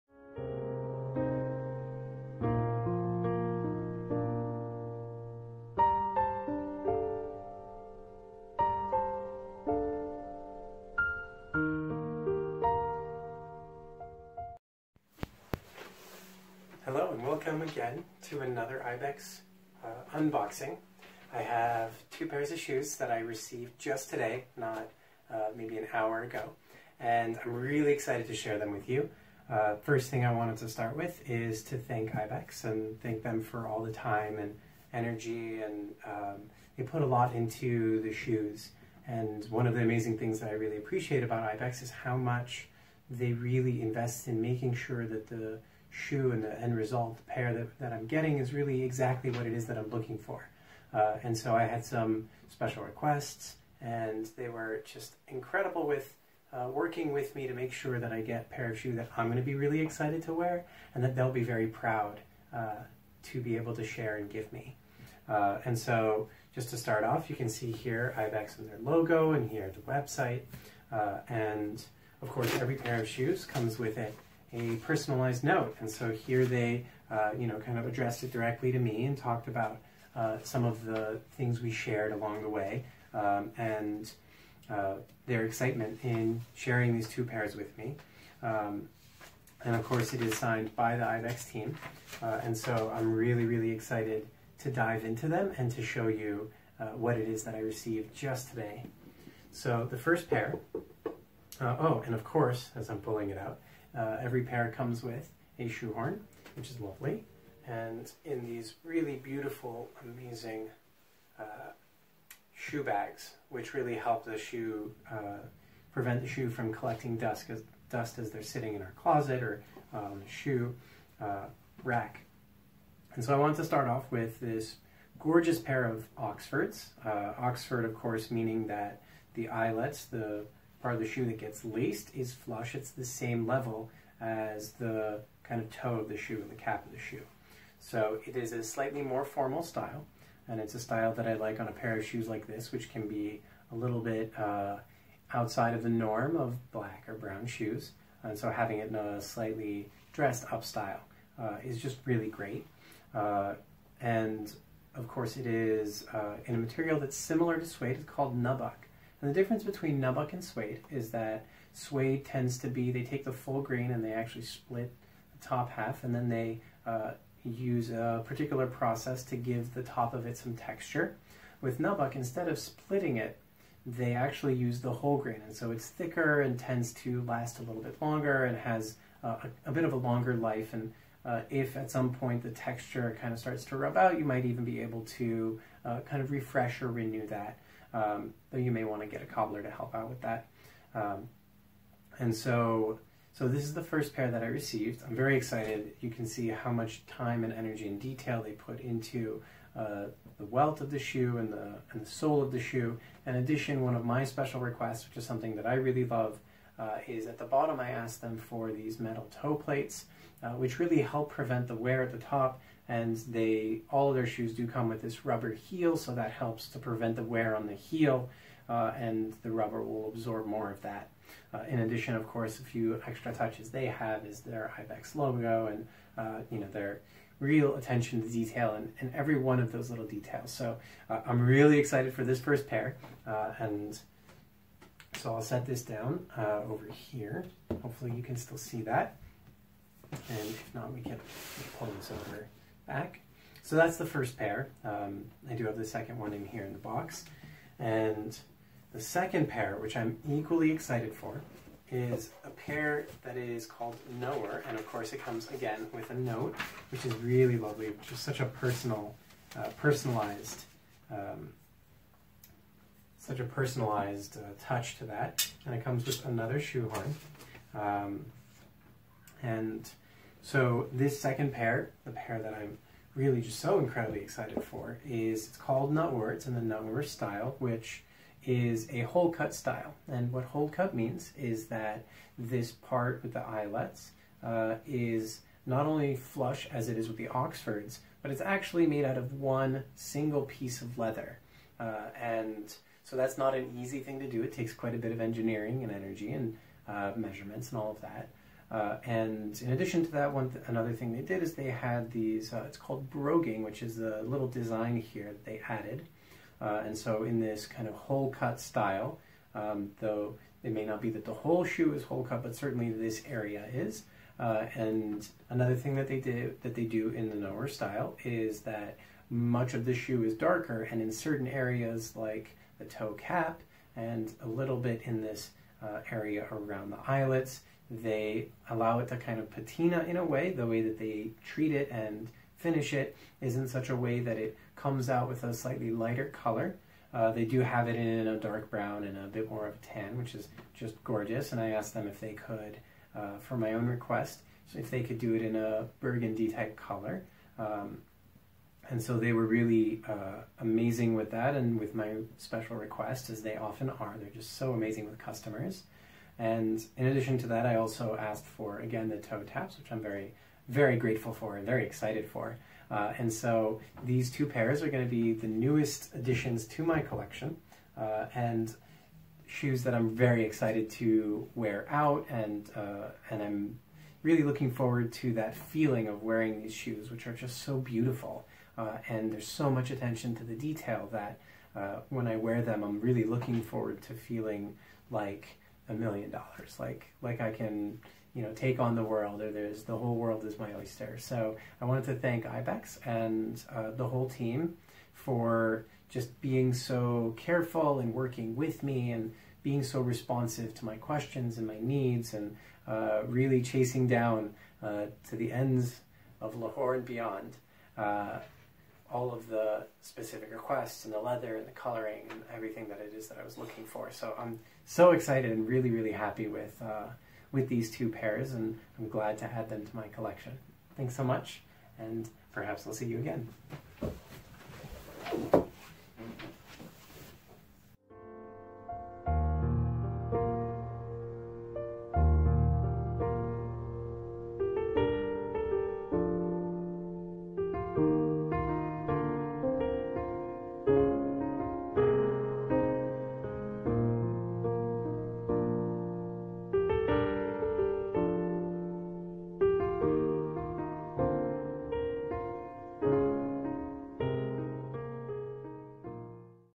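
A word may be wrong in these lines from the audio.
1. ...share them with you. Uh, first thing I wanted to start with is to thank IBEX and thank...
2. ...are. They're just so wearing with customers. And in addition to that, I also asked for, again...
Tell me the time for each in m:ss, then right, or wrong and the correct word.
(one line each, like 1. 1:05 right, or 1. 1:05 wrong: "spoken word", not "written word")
1. 0:28 right
2. 5:53 wrong: "amazing", not "wearing".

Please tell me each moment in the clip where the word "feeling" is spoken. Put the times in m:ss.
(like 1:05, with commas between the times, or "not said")
6:15, 6:24.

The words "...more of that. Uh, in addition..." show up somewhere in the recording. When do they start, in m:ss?
3:40.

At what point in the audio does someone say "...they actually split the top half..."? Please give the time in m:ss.
2:44.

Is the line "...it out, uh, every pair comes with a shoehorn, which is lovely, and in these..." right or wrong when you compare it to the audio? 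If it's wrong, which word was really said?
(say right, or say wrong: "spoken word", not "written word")
right.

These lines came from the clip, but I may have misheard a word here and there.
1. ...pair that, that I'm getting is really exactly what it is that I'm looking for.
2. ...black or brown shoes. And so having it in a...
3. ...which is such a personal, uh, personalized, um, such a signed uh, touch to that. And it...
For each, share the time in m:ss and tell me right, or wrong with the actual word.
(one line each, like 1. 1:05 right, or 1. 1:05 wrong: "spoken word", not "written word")
1. 0:47 right
2. 2:26 right
3. 4:17 wrong: "personalized", not "signed".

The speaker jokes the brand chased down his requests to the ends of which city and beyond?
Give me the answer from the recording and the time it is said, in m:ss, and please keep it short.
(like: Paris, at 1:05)
Lahore, at 6:46.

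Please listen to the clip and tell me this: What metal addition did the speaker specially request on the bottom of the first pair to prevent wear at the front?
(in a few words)
Metal toe plates.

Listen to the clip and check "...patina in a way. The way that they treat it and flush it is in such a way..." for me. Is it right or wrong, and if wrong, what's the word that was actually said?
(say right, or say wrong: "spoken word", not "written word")
wrong: "finish", not "flush".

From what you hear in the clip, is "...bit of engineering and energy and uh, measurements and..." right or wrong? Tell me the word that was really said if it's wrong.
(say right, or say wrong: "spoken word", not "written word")
right.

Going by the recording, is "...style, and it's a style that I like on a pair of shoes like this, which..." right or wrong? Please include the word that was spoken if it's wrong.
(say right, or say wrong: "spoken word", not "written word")
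right.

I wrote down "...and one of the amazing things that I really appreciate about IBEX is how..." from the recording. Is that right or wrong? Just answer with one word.
right.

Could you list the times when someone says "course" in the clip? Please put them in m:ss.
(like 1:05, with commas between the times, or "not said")
1:12, 1:29, 1:42, 2:07, 2:35, 3:42, 4:14.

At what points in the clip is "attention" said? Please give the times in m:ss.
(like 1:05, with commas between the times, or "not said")
3:47, 6:19.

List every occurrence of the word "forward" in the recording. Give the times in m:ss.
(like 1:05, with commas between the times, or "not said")
6:14, 6:23.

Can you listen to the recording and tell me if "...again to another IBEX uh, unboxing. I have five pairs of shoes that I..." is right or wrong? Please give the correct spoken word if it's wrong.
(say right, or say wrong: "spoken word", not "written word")
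wrong: "two", not "five".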